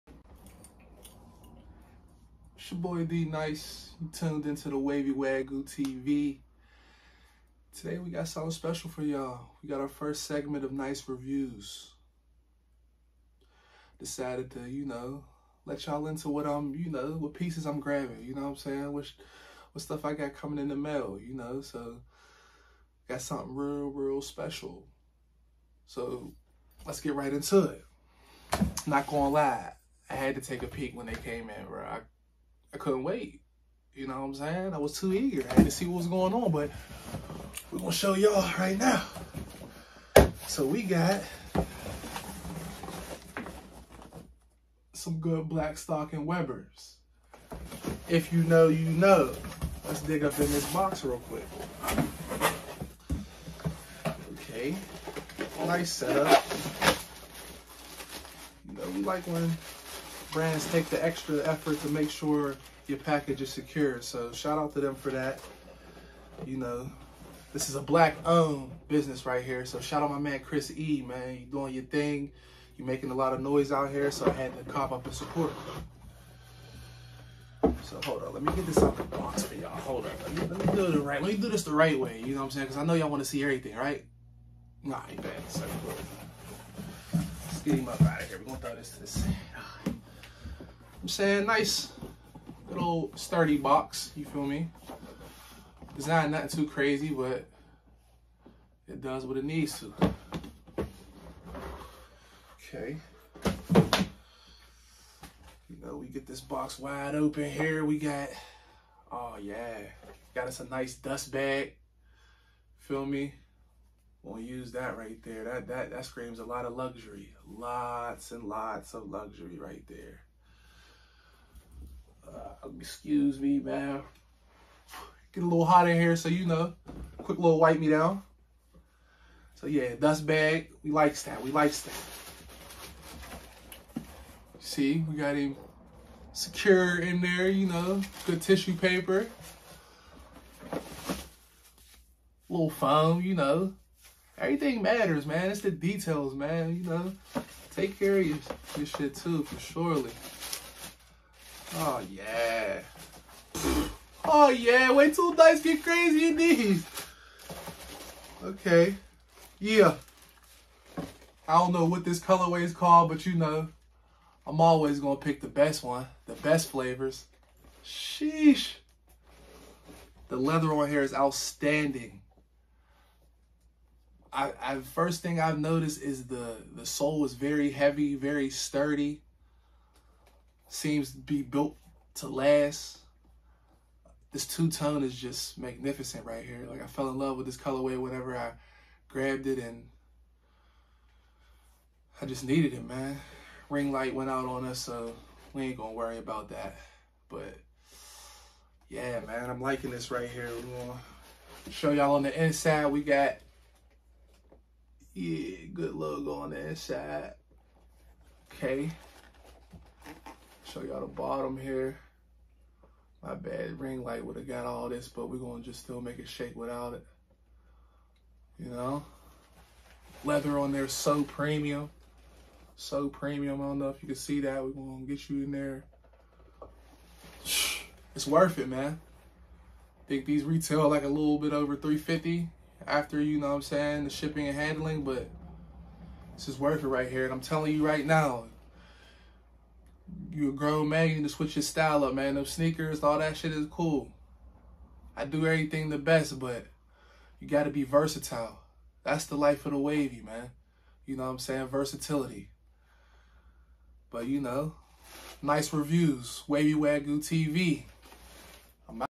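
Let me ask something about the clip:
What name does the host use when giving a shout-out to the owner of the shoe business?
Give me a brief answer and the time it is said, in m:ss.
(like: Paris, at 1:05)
Chris E, at 1:10.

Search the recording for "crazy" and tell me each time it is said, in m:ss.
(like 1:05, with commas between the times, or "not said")
1:36, 2:35.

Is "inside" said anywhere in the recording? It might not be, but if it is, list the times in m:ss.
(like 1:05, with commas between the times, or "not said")
3:22, 3:26.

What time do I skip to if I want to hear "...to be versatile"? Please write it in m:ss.
4:07.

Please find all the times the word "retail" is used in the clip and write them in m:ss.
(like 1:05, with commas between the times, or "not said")
3:50.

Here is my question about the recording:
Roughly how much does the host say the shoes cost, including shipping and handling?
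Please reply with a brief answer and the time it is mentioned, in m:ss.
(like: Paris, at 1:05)
a little over 350, at 3:51.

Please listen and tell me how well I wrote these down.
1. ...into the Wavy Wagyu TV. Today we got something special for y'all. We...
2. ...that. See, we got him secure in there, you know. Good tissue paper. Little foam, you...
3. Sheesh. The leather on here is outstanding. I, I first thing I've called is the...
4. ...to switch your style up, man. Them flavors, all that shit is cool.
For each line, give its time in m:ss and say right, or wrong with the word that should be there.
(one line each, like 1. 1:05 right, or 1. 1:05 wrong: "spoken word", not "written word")
1. 0:04 right
2. 2:11 right
3. 2:47 wrong: "noticed", not "called"
4. 4:01 wrong: "sneakers", not "flavors".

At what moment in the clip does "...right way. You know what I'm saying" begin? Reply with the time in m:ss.
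1:21.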